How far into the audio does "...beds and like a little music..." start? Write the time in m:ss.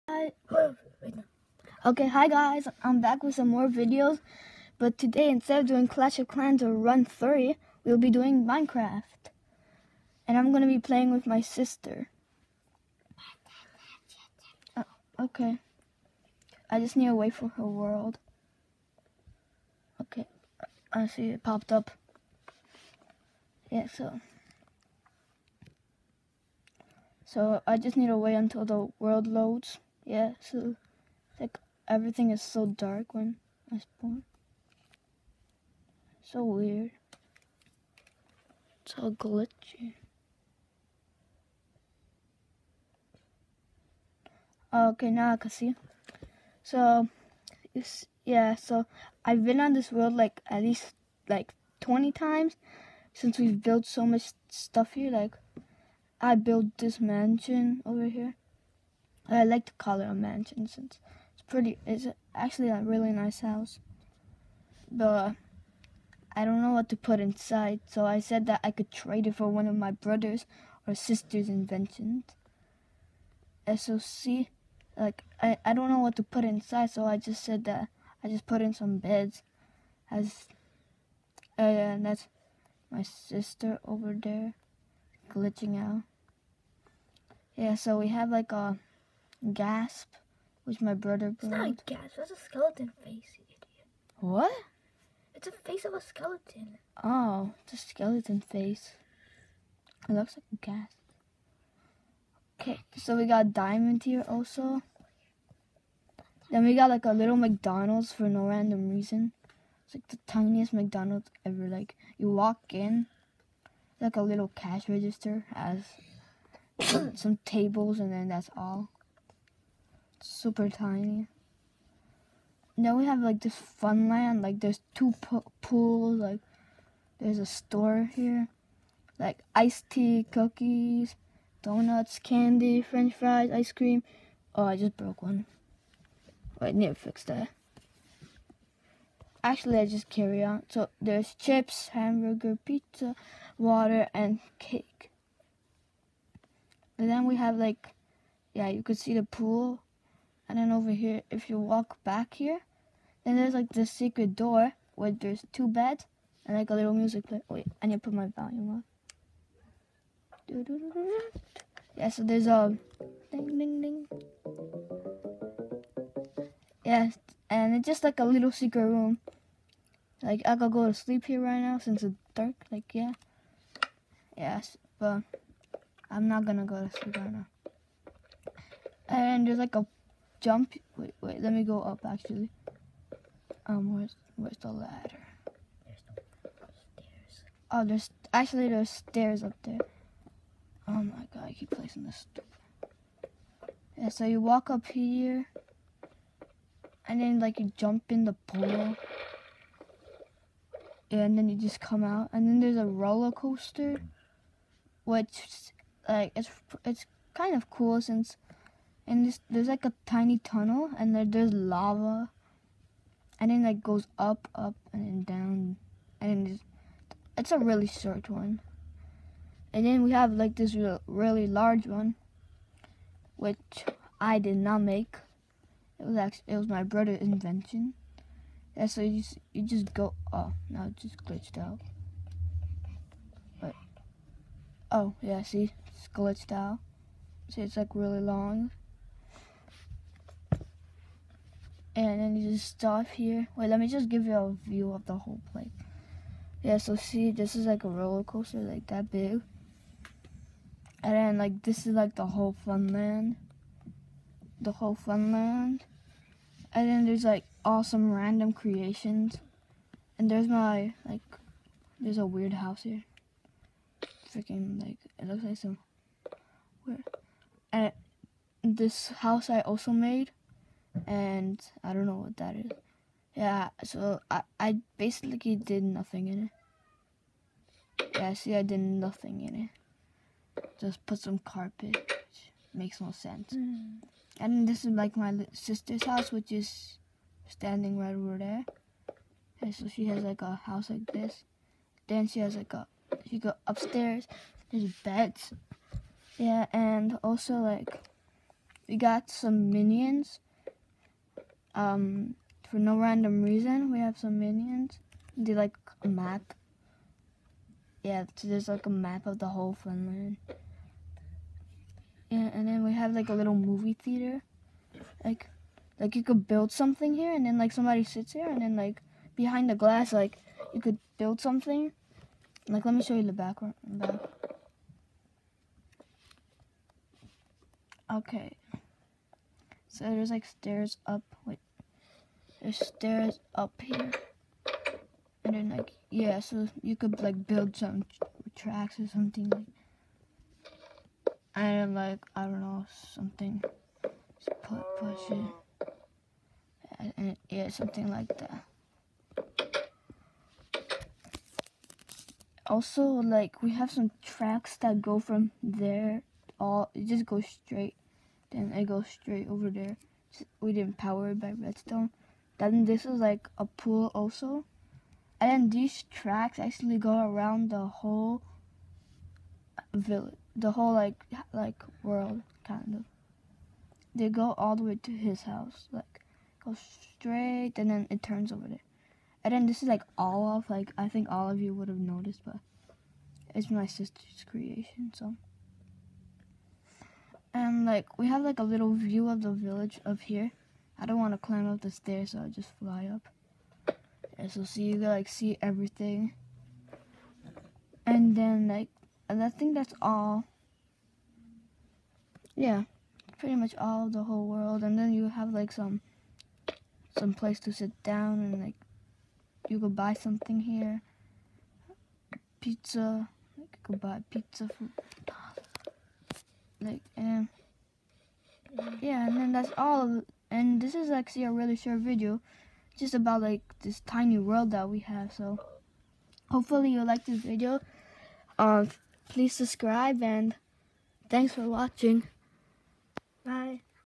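2:35.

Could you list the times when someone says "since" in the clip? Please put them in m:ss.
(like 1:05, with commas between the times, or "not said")
0:53, 1:00, 2:51, 3:28.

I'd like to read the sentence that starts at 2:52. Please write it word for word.
Like yeah, yes, but I'm not gonna go to sleep right now.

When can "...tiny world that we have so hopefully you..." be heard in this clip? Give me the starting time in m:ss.
7:04.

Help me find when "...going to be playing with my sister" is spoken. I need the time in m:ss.
0:10.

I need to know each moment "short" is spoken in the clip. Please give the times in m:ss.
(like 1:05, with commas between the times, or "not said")
3:37, 7:01.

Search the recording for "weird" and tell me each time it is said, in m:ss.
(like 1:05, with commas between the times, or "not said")
0:36, 4:22, 4:26.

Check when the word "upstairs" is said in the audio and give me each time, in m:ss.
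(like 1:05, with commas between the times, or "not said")
4:53.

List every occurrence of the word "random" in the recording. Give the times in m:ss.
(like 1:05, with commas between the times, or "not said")
1:48, 4:18, 5:02.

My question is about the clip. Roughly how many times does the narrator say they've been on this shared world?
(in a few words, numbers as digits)
20.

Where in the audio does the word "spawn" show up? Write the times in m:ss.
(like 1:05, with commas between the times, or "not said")
0:33.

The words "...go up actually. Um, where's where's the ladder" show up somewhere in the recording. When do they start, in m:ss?
3:01.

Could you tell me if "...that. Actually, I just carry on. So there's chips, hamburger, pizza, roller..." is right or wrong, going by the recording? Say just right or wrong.
wrong.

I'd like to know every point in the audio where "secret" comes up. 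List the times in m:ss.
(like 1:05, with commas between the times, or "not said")
2:33, 2:48.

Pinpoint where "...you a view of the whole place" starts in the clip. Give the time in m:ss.
4:04.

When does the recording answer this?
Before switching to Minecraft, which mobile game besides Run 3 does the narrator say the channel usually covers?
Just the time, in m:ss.
0:05.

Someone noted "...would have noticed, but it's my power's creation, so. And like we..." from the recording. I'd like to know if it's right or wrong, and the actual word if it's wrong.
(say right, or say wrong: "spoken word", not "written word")
wrong: "sister", not "power".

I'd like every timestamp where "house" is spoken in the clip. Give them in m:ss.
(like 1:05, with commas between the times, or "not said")
1:03, 4:22, 4:29, 4:46, 4:50, 6:15.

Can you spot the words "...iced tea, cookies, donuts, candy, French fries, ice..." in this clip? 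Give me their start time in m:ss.
2:09.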